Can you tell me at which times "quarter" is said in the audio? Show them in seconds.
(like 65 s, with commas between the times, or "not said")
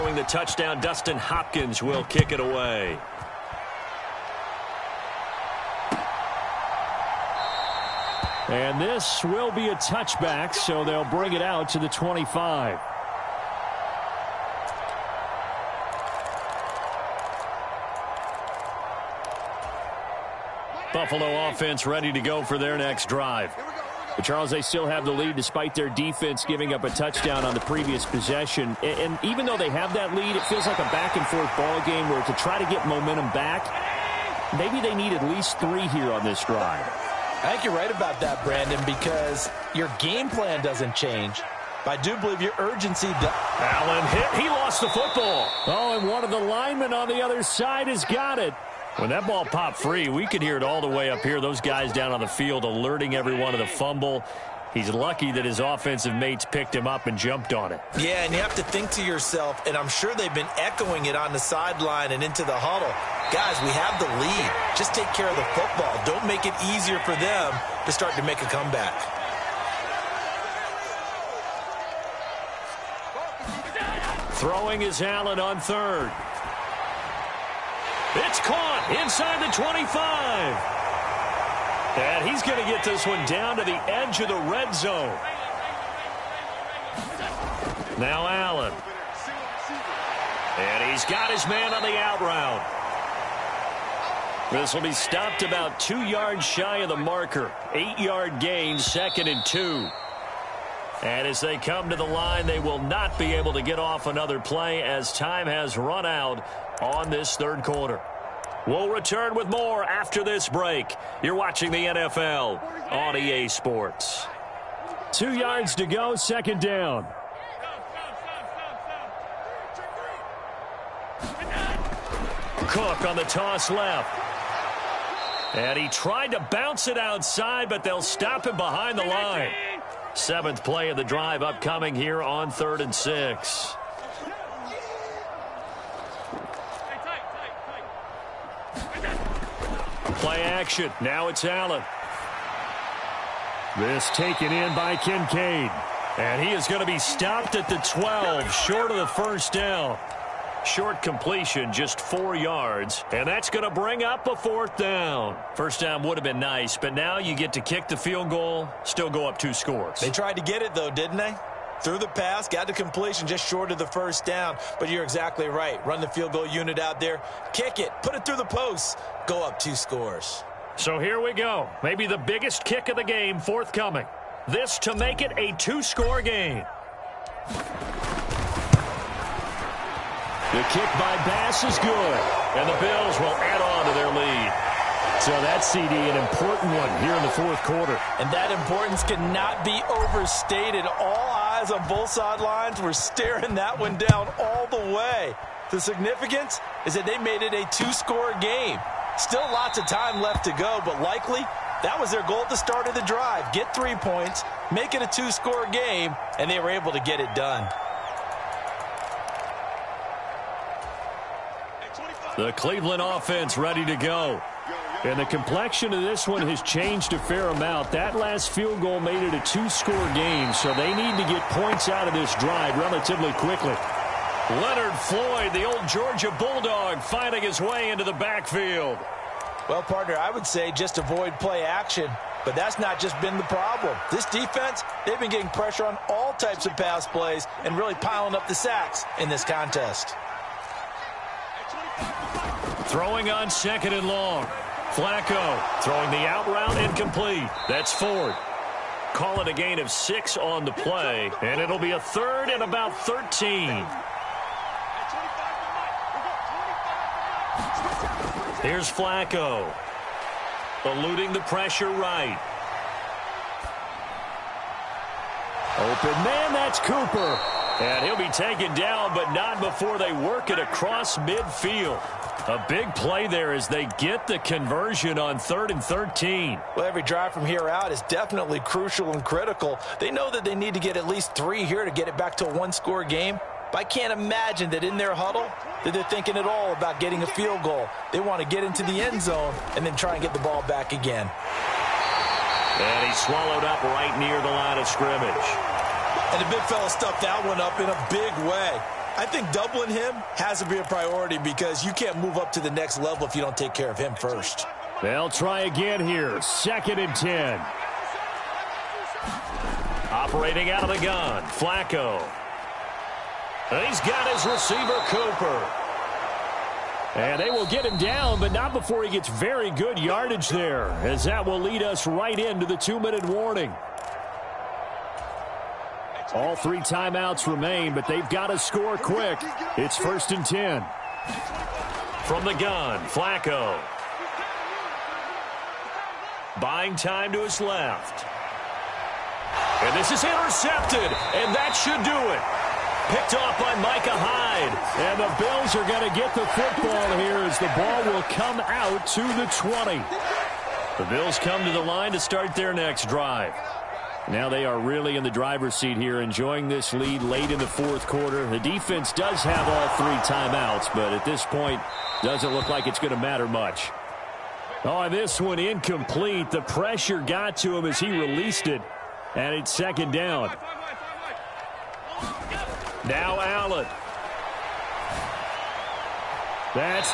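107 s, 187 s, 358 s.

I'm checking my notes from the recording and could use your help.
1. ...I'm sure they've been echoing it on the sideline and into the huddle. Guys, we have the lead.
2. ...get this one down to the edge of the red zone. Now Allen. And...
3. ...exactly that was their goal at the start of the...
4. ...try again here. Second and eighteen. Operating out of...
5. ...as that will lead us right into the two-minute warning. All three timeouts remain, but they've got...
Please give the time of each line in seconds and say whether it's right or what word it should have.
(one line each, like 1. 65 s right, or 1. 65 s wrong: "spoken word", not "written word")
1. 59 s right
2. 82 s right
3. 201 s wrong: "likely", not "exactly"
4. 305 s wrong: "ten", not "eighteen"
5. 321 s right.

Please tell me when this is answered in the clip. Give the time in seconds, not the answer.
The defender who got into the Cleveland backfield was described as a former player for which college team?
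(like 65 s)
225 s.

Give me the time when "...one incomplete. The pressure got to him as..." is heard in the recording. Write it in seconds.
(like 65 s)
365 s.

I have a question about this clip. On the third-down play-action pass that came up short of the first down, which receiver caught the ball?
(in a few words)
Kincaid.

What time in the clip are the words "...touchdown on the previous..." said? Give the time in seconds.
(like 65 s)
26 s.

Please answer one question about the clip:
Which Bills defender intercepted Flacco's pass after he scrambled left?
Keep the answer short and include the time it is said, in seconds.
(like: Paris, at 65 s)
Micah Hyde, at 343 s.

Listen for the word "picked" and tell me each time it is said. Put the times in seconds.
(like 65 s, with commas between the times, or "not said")
56 s, 343 s.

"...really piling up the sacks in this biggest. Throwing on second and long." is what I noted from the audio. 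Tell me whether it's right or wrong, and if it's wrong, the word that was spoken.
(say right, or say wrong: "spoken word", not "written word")
wrong: "contest", not "biggest".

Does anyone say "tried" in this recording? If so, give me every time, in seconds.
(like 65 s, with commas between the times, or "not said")
125 s, 160 s.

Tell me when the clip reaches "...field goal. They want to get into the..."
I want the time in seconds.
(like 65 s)
287 s.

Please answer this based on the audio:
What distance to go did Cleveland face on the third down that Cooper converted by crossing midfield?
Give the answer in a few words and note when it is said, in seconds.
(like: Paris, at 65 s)
13, at 275 s.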